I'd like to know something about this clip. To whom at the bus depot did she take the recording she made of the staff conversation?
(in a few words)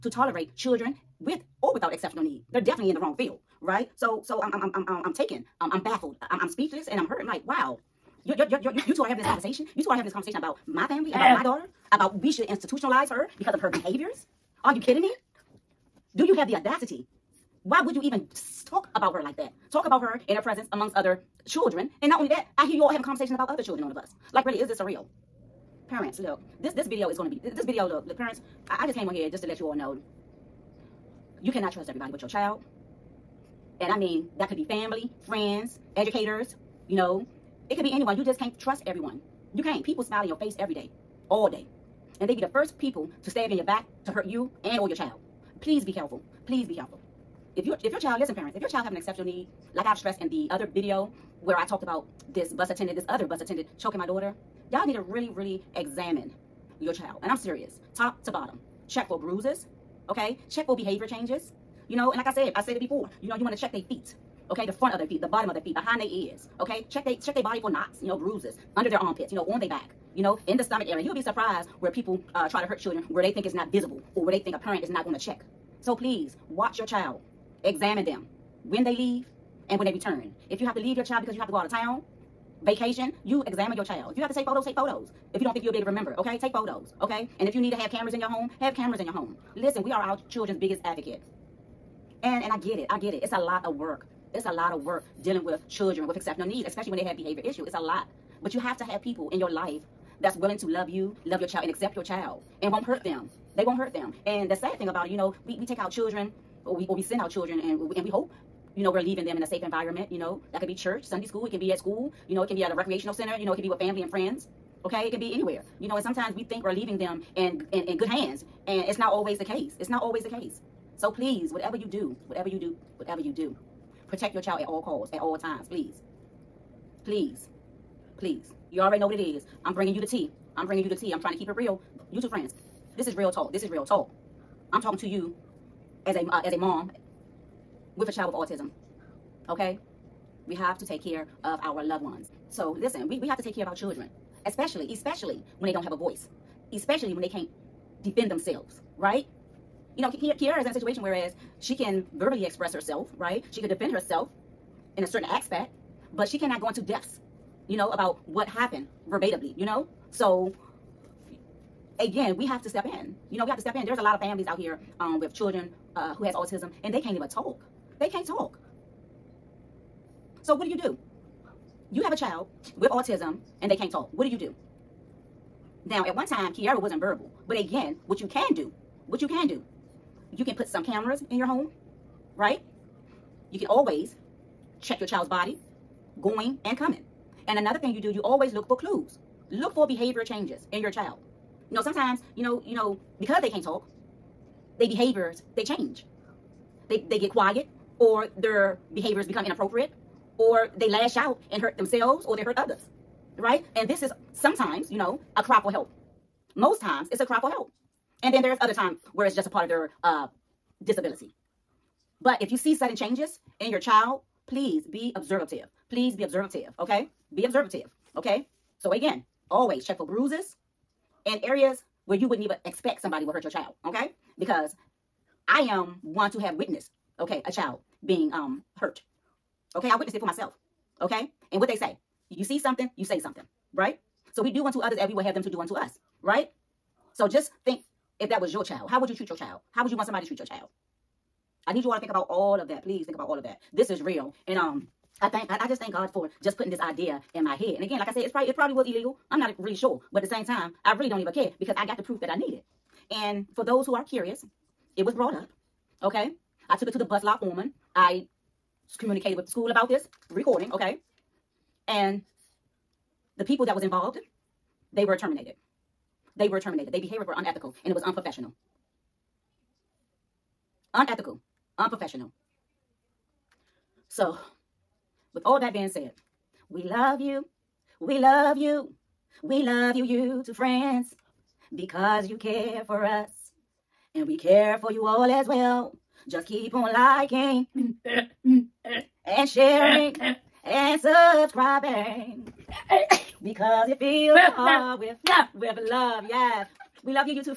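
bus lot foreman.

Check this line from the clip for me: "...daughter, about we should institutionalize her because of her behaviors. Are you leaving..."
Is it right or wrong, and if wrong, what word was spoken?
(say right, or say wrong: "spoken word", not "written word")
wrong: "kidding", not "leaving".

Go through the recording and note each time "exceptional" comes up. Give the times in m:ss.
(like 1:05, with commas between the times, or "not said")
0:01, 0:48, 1:36.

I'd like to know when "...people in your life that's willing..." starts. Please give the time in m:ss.
1:39.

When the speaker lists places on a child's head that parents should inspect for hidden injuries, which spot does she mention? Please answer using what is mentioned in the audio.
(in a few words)
behind their ears.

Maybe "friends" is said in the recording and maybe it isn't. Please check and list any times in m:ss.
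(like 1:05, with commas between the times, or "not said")
0:35, 1:54, 2:12, 4:40.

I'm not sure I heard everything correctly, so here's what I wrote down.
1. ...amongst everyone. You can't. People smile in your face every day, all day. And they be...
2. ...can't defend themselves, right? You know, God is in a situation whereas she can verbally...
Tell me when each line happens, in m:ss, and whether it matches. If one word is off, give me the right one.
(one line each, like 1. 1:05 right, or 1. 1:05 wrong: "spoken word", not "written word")
1. 0:38 wrong: "trust", not "amongst"
2. 2:27 wrong: "Kiara", not "God".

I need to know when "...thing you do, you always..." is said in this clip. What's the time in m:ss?
3:07.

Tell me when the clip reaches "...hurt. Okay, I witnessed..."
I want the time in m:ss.
3:48.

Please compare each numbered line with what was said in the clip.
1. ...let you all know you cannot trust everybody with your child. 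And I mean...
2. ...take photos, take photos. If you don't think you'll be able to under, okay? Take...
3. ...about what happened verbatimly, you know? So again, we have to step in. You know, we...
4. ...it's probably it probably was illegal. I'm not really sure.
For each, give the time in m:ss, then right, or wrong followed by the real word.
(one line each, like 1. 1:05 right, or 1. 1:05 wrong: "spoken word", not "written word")
1. 0:29 right
2. 1:24 wrong: "remember", not "under"
3. 2:37 right
4. 4:08 right.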